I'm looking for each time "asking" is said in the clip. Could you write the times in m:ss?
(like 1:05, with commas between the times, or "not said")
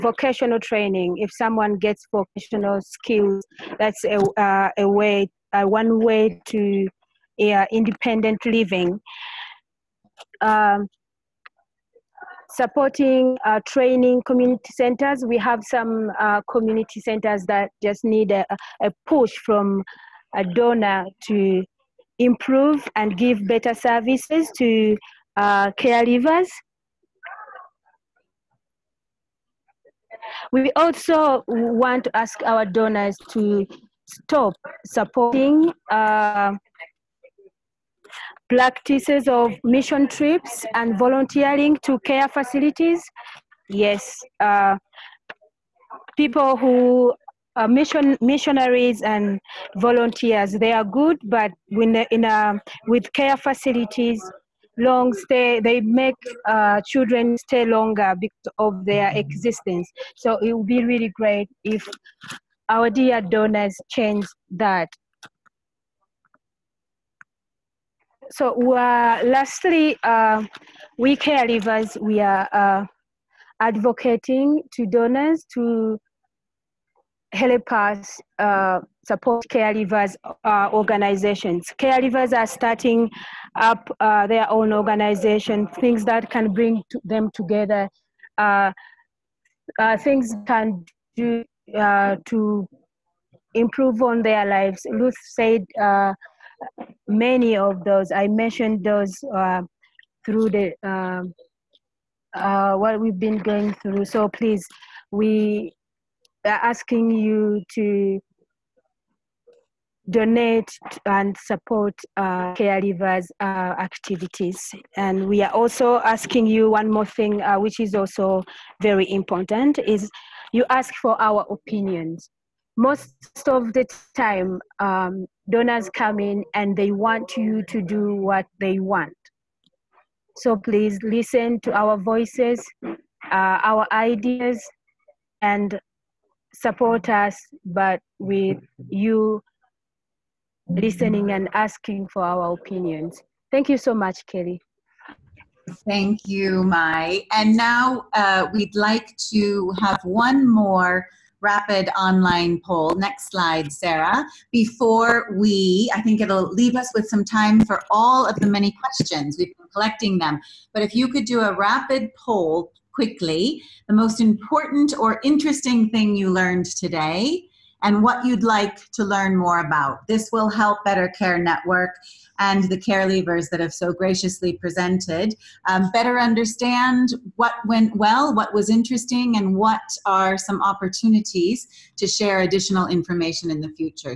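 1:46, 1:55, 2:21.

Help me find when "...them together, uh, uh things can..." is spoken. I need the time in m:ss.
1:27.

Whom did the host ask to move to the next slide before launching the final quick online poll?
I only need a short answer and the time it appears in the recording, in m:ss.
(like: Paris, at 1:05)
Sarah, at 2:33.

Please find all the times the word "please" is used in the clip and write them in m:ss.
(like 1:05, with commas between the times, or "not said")
1:44, 2:10.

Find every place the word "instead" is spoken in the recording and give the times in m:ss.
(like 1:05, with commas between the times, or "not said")
not said.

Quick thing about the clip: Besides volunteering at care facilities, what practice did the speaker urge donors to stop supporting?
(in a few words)
Mission trips.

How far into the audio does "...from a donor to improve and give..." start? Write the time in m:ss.
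0:19.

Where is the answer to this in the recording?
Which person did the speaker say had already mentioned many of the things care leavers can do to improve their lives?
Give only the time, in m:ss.
1:34.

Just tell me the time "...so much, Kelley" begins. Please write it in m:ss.
2:23.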